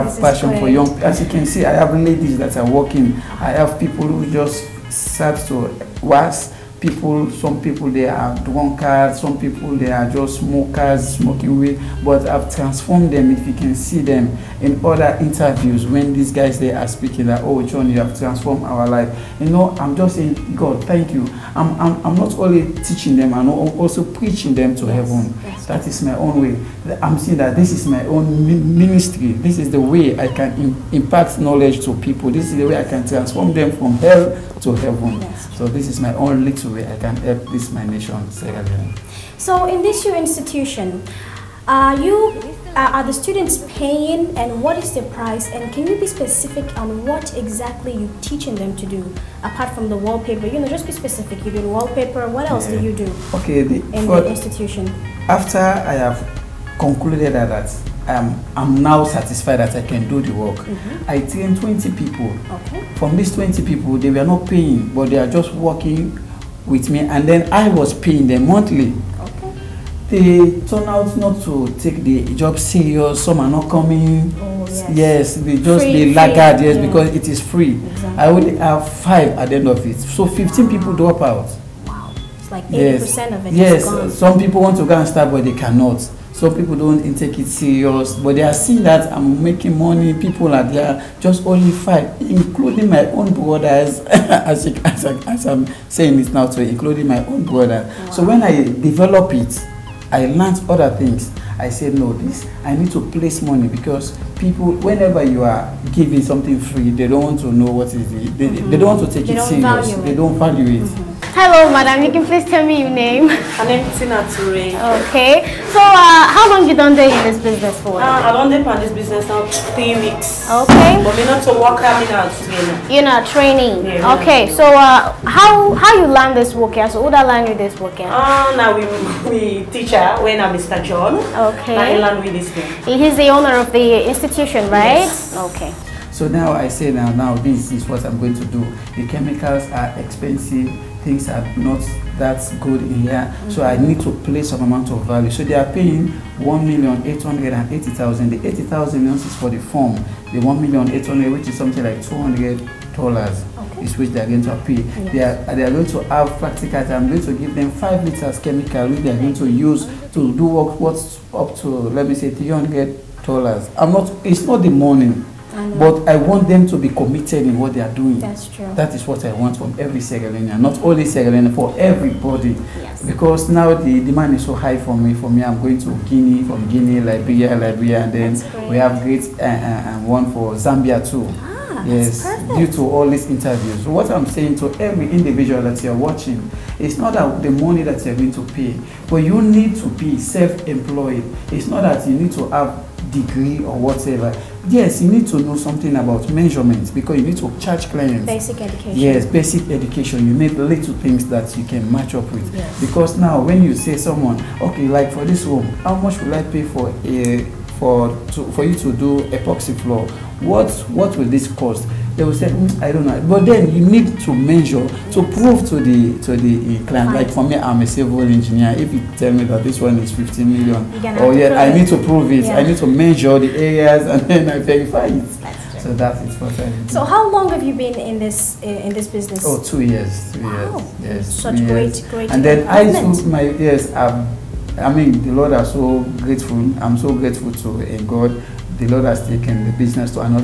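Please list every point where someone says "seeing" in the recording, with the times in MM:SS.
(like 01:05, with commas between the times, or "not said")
00:27, 01:28.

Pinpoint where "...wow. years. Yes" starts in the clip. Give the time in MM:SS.
03:50.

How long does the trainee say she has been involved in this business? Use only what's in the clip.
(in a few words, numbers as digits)
3 weeks.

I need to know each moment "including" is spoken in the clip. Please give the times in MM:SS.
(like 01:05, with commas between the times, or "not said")
01:32, 01:36.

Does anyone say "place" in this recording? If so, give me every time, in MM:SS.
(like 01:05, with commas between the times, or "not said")
01:43, 02:24.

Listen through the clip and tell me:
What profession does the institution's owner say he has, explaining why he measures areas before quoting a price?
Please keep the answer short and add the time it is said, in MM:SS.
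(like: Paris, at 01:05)
Civil engineer, at 03:37.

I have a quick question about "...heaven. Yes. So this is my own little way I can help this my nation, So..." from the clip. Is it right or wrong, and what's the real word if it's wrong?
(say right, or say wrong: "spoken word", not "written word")
right.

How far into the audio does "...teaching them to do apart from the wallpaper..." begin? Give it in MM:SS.
00:48.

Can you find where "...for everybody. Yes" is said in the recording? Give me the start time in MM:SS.
02:51.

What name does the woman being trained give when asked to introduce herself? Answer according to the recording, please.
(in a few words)
Tina Ture.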